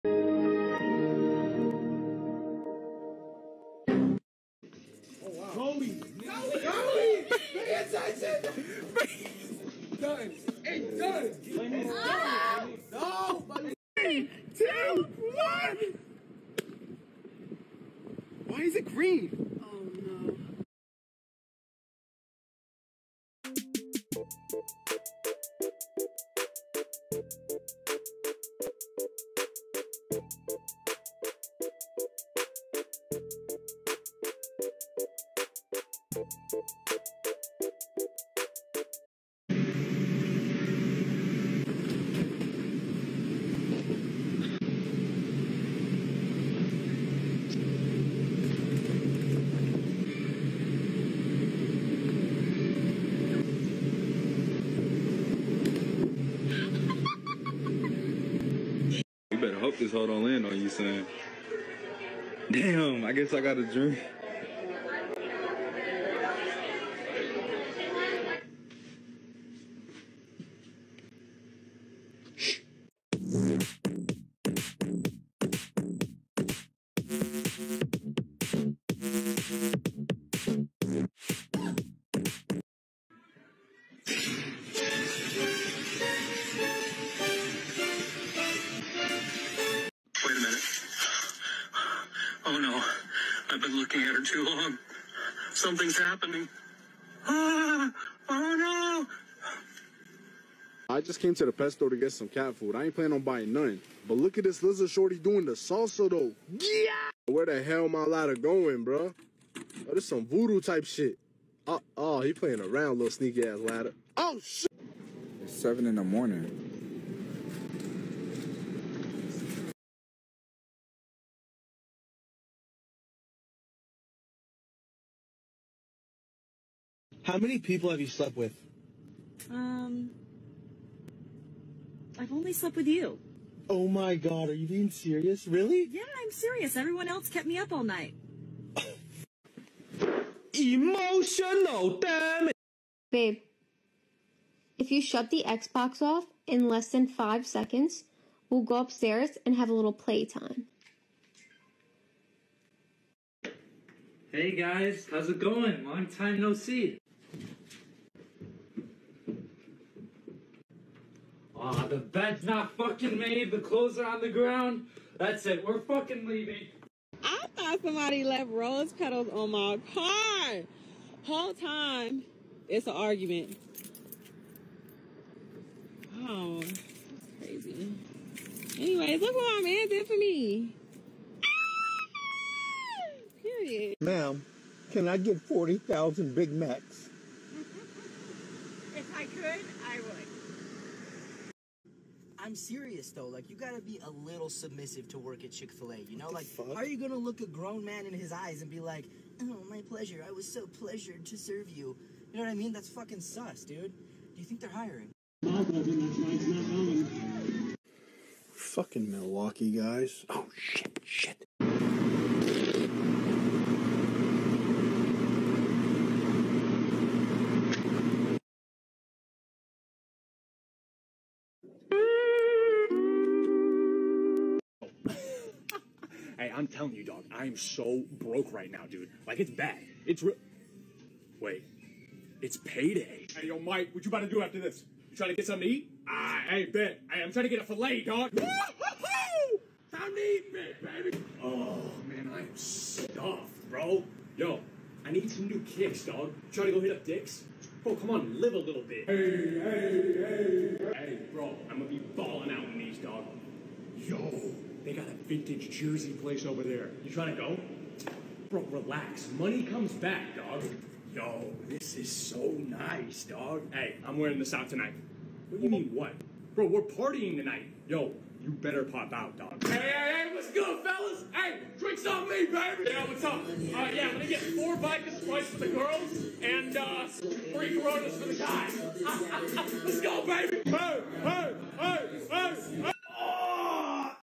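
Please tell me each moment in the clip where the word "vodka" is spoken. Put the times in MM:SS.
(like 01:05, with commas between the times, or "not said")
04:34.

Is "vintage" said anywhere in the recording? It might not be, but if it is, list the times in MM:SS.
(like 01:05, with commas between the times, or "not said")
04:15.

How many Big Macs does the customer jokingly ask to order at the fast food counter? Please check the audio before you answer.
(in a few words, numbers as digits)
40,000.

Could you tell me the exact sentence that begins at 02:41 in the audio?
Aw, oh, the bed's not fucking made, the clothes are on the ground.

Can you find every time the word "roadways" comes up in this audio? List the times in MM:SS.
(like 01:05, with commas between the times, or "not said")
not said.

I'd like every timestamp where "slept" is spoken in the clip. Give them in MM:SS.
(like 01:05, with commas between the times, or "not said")
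02:08, 02:12.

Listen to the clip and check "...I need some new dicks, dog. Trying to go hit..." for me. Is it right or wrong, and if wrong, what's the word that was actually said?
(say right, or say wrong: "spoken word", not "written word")
wrong: "kicks", not "dicks".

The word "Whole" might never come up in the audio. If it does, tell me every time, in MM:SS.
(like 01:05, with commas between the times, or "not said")
02:51.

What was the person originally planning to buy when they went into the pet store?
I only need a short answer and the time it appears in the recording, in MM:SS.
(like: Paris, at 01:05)
Cat food, at 01:42.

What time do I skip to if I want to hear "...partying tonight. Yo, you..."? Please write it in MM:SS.
04:26.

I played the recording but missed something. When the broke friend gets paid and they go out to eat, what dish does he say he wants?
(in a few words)
Filet.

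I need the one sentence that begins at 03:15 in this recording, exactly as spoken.
You know, like how are you gonna look a grown man in his eyes and be like, "Oh, my pleasure.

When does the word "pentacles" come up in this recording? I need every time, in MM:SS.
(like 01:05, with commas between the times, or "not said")
not said.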